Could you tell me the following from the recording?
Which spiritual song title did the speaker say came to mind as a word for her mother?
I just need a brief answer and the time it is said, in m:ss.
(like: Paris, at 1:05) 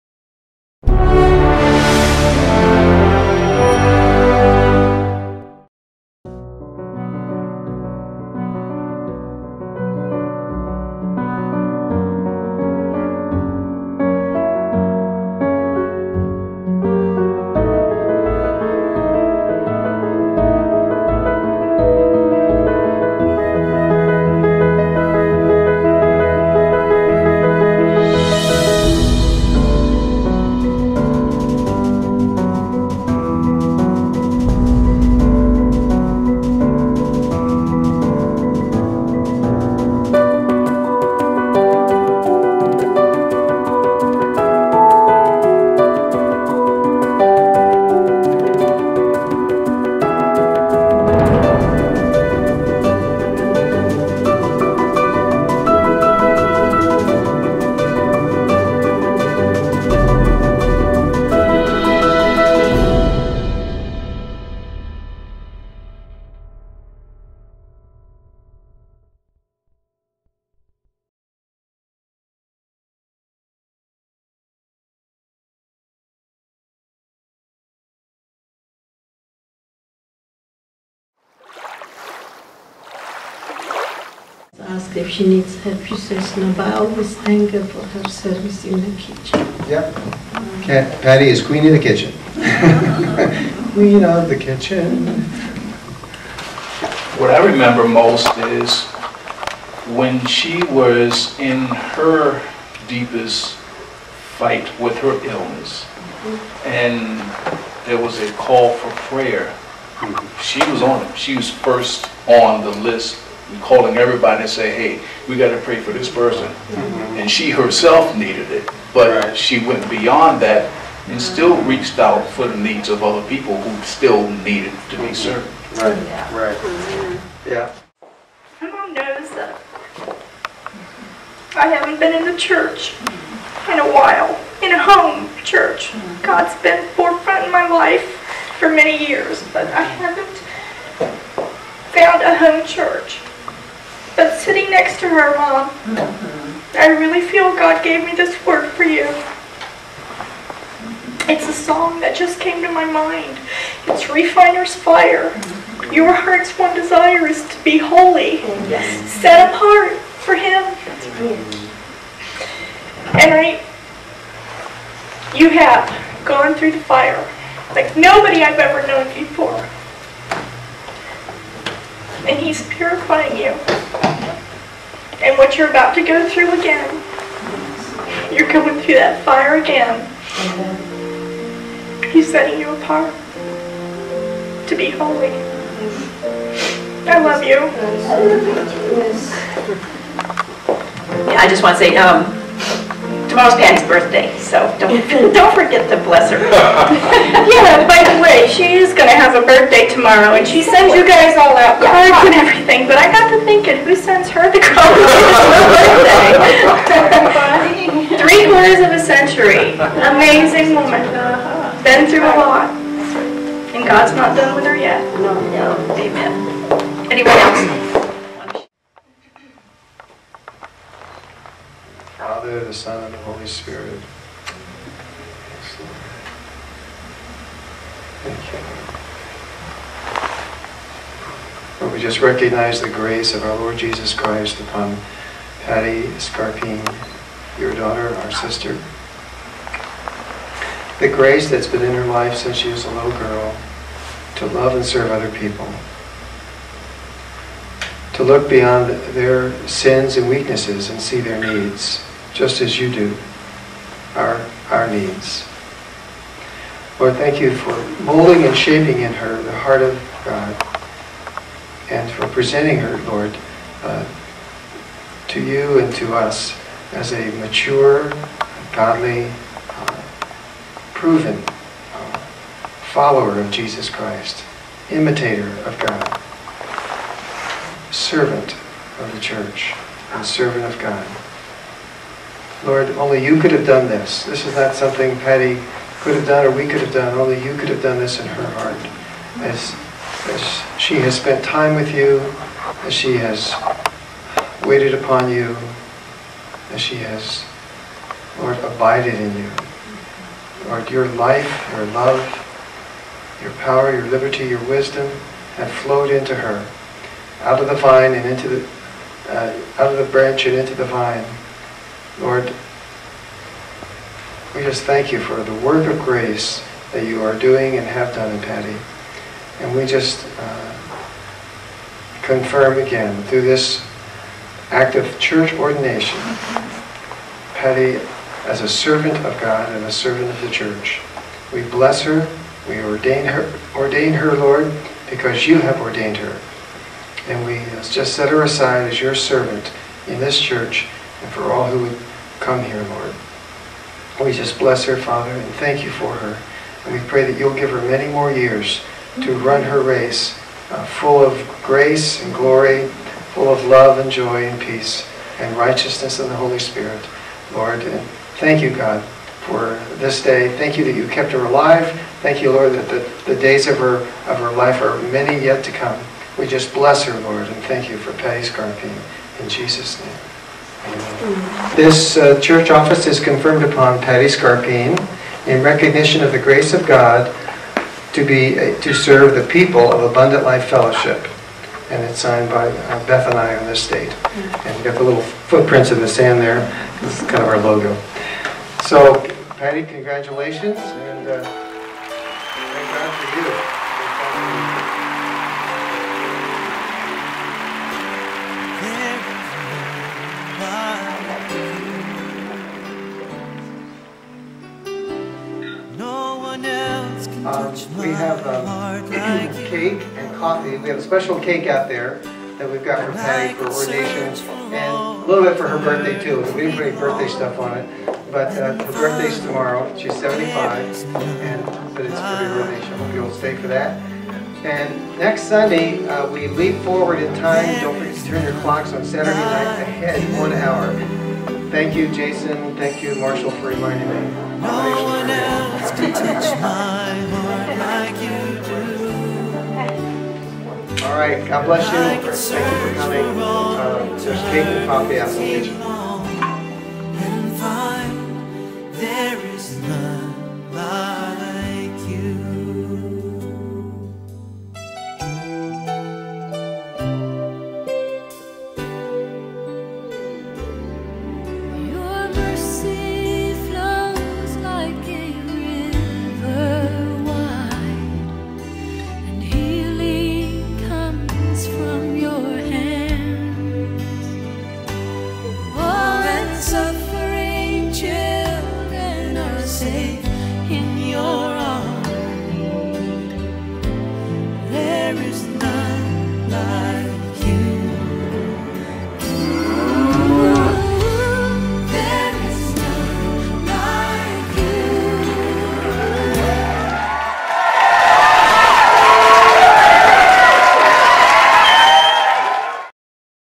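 Refiner's Fire, at 2:34.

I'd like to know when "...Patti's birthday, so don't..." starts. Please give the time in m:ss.
3:13.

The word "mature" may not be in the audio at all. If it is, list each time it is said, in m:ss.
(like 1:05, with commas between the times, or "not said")
4:27.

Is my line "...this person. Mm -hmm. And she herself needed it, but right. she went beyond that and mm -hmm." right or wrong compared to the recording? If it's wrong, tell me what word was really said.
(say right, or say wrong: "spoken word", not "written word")
right.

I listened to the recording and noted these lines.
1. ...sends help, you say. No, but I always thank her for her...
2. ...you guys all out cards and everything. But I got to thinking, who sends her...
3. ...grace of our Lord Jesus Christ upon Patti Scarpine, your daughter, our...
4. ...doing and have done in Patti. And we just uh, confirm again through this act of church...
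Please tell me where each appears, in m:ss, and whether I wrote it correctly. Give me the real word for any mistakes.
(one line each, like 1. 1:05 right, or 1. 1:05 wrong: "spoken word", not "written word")
1. 1:25 wrong: "needs", not "sends"
2. 3:20 right
3. 3:52 right
4. 5:17 right.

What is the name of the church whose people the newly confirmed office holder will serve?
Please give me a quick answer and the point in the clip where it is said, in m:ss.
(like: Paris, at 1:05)
Abundant Life Fellowship, at 6:20.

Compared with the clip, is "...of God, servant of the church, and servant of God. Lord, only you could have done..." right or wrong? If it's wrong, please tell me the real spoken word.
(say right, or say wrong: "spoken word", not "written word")
right.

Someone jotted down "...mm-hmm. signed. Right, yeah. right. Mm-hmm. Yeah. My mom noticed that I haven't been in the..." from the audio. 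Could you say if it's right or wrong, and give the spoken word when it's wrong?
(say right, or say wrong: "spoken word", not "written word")
wrong: "served", not "signed".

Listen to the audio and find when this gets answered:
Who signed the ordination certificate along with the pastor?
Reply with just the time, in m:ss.
6:23.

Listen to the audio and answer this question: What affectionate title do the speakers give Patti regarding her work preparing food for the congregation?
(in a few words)
Queen of the kitchen.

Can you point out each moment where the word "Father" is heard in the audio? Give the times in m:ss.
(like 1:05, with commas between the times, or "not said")
3:42, 5:44.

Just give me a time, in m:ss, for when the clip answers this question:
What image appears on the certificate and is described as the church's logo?
6:25.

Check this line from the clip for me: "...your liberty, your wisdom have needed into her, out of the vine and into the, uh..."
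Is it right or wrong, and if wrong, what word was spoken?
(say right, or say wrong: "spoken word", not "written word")
wrong: "flowed", not "needed".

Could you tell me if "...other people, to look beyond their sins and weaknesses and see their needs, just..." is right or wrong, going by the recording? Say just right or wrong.
right.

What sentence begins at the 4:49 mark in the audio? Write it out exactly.
As, as she has spent time with you, as she has waited upon you, as she has, Lord, abided in you.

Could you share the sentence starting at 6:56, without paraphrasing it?
We didn't put any birthday stuff on it.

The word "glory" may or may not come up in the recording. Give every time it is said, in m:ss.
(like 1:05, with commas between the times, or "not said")
5:52.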